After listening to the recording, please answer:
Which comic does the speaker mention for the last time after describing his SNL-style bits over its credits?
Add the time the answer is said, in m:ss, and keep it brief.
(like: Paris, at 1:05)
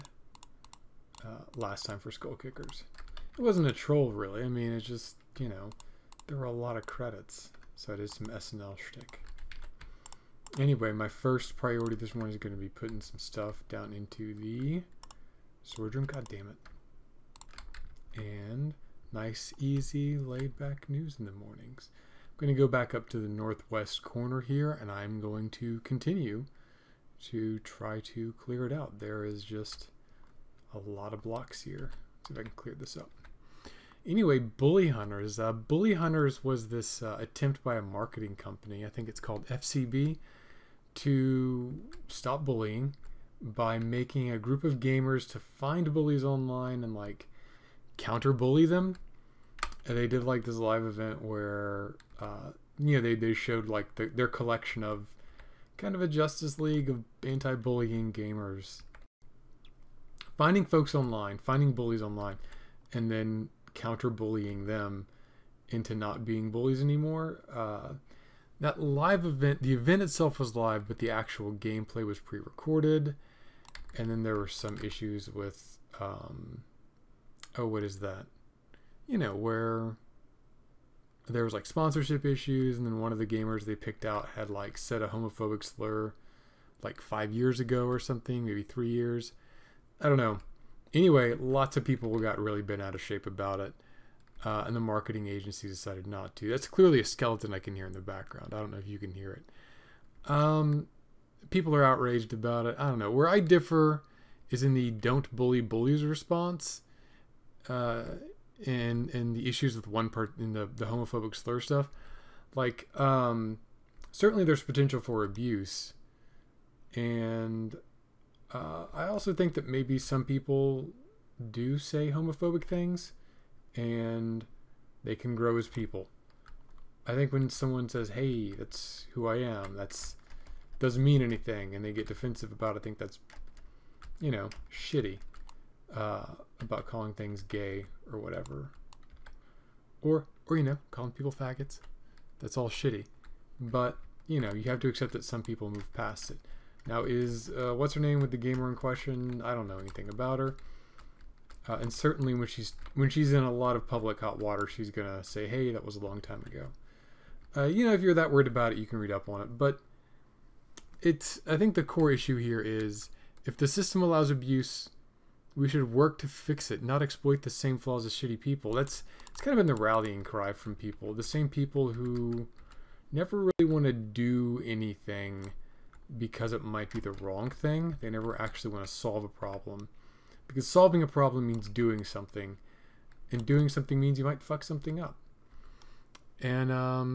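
Skullkickers, at 0:02.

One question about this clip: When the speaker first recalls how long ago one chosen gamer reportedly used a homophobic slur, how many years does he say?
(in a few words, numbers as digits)
5.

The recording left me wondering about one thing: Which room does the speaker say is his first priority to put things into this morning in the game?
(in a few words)
sword room.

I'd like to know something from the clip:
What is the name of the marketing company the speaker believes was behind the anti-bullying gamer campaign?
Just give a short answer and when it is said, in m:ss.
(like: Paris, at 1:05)
FCB, at 0:39.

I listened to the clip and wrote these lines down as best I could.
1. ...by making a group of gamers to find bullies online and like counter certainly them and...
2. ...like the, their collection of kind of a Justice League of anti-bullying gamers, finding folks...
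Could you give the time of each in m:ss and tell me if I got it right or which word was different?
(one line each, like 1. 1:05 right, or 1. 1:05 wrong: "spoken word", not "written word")
1. 0:43 wrong: "bully", not "certainly"
2. 0:53 right.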